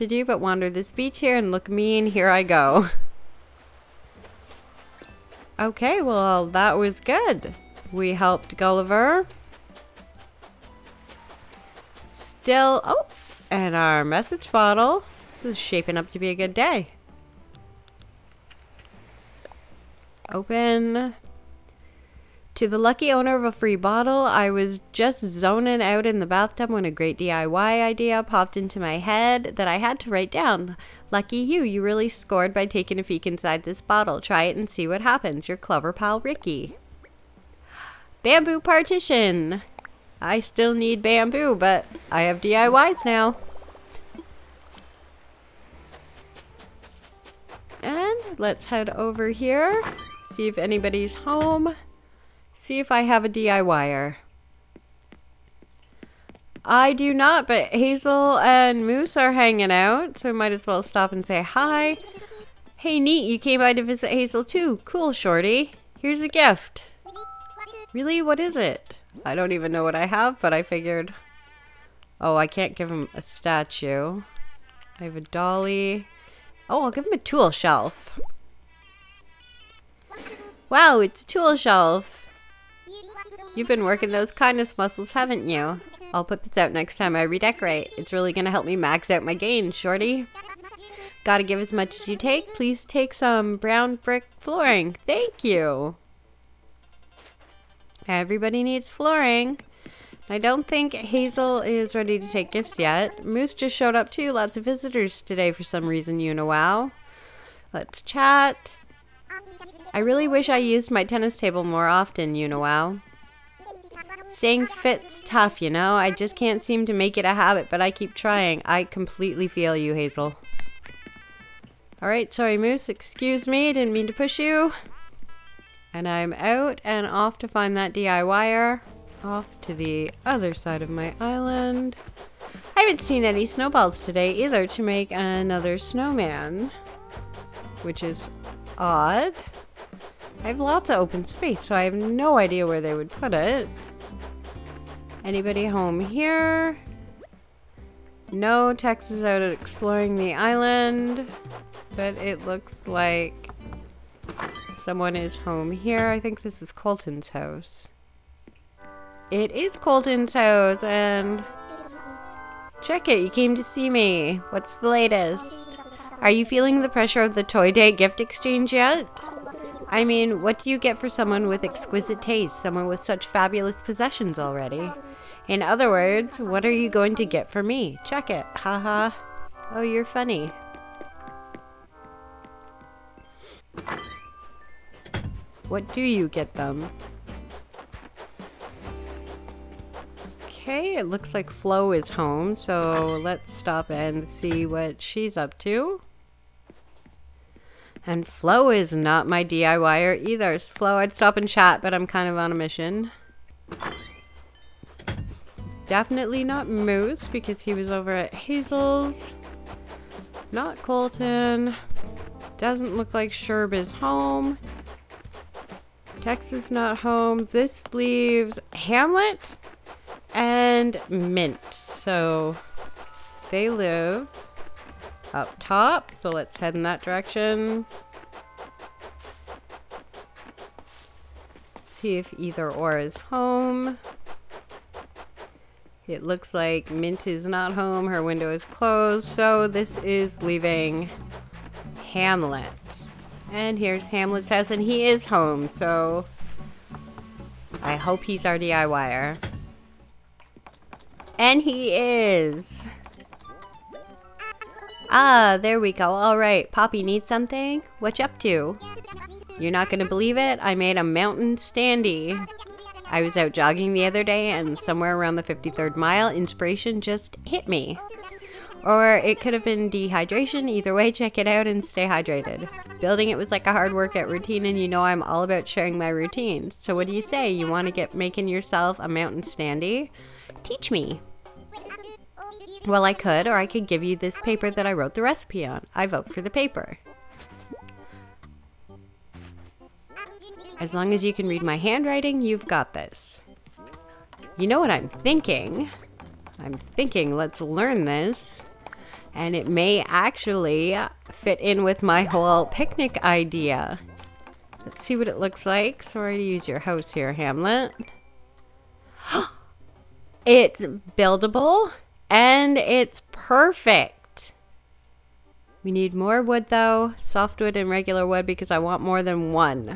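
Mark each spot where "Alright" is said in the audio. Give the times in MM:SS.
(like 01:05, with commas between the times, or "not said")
02:02, 04:16.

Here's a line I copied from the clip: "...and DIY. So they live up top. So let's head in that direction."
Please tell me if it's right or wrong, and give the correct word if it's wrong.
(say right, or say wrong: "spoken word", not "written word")
wrong: "Mint", not "DIY".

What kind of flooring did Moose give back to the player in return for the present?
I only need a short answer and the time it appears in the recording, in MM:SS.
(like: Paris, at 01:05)
Brown brick flooring, at 01:33.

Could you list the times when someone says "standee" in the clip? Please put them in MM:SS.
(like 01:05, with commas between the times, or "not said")
04:21, 04:39.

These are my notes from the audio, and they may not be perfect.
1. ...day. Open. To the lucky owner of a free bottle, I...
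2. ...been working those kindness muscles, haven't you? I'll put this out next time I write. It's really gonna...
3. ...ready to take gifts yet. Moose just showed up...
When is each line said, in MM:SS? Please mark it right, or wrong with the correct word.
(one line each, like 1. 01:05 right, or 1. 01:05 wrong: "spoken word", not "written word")
1. 00:16 right
2. 01:23 wrong: "redecorate", not "write"
3. 01:41 right.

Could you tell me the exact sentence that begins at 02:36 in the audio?
I think this is Colton's house.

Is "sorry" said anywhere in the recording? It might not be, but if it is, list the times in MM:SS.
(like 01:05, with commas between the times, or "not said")
02:02, 05:06.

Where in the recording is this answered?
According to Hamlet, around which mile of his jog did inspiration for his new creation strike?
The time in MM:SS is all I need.
04:25.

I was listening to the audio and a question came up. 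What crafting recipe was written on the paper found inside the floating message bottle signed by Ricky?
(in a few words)
Bamboo partition.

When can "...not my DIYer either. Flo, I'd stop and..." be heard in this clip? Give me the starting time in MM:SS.
03:18.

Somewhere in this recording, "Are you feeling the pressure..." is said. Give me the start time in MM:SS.
02:46.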